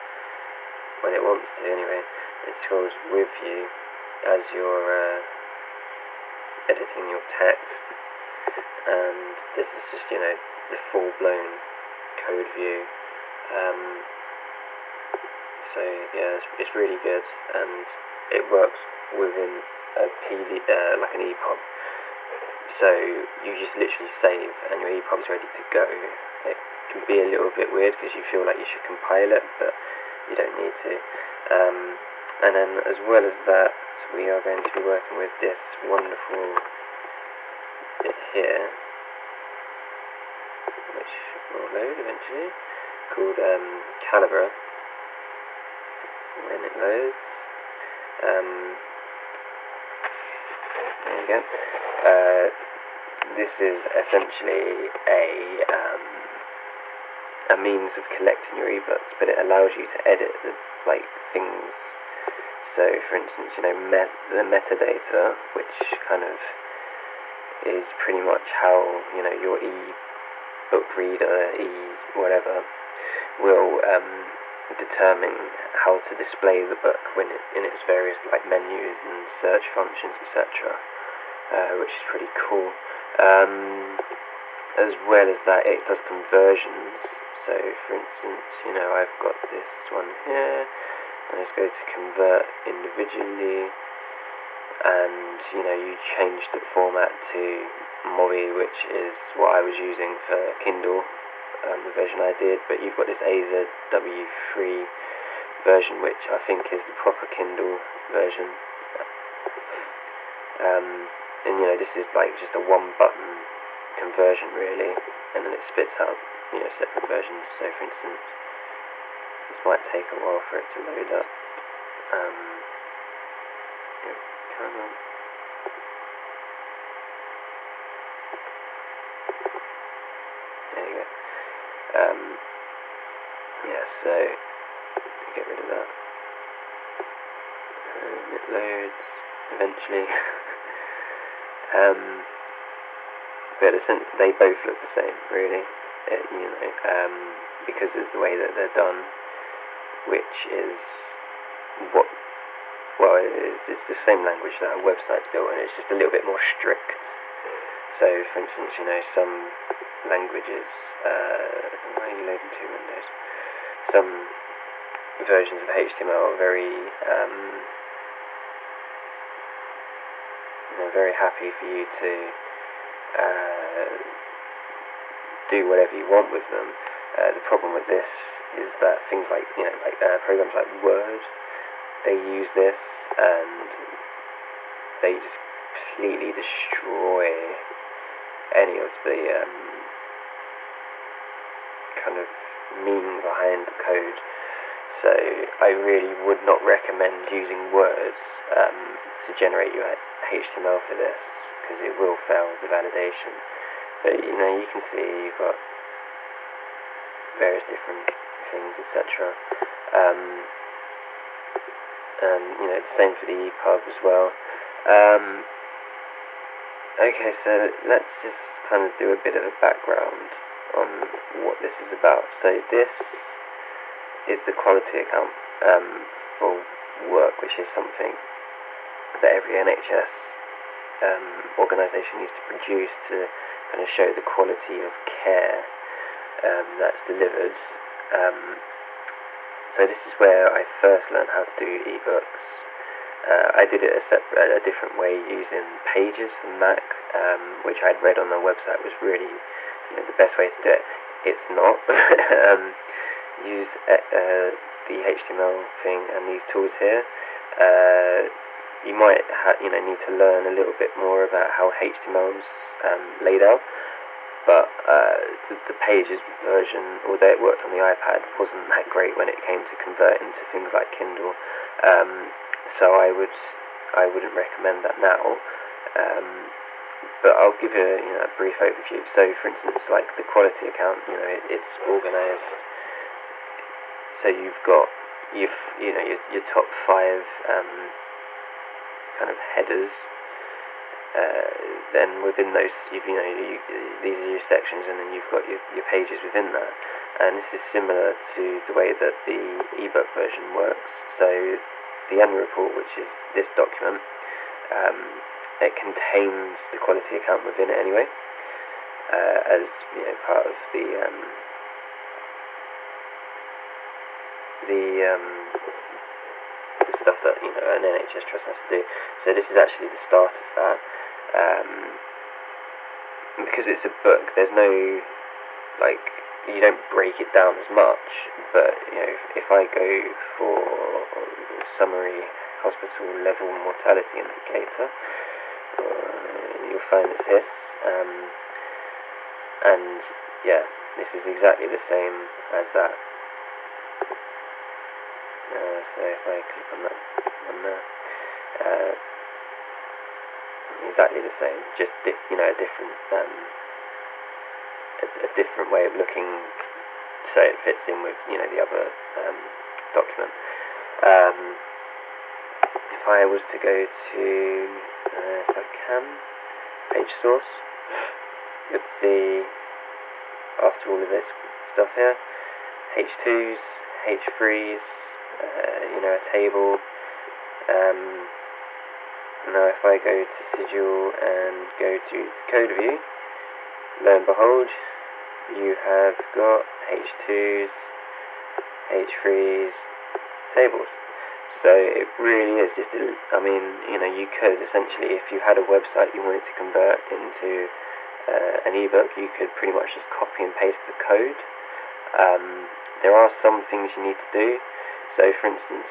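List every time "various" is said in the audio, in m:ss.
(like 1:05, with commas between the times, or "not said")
1:17, 3:27.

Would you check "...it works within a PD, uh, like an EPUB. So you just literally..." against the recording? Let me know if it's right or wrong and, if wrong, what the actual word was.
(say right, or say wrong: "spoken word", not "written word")
right.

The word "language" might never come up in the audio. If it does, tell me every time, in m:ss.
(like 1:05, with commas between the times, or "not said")
2:34, 2:40.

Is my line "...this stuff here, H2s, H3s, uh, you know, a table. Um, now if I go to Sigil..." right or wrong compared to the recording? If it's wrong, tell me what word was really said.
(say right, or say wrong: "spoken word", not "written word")
right.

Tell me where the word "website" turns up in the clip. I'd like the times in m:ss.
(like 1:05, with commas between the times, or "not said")
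2:34, 4:08, 6:35.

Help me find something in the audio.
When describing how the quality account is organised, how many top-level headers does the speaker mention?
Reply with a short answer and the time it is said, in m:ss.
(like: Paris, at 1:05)
5, at 4:46.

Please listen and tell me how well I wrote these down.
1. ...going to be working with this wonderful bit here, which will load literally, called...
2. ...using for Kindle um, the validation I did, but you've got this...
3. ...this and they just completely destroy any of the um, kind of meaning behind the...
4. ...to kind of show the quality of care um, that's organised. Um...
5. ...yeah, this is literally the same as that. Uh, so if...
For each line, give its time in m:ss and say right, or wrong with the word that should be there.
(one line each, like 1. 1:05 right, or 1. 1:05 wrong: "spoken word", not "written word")
1. 0:34 wrong: "eventually", not "literally"
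2. 1:39 wrong: "version", not "validation"
3. 3:02 right
4. 3:53 wrong: "delivered", not "organised"
5. 5:40 wrong: "exactly", not "literally".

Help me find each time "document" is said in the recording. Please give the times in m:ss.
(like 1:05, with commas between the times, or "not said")
5:03, 5:59.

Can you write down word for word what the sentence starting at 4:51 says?
Uh, then within those, you've, you know, you, these are your sections, and then you've got your, your pages within that.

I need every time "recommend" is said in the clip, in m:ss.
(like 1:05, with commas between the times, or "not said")
3:16, 4:34.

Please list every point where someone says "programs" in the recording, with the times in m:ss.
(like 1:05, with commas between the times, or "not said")
3:00.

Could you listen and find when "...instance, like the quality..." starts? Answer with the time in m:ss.
4:39.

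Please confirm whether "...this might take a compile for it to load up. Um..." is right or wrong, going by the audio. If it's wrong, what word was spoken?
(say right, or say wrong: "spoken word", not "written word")
wrong: "while", not "compile".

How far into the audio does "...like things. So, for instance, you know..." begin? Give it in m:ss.
1:00.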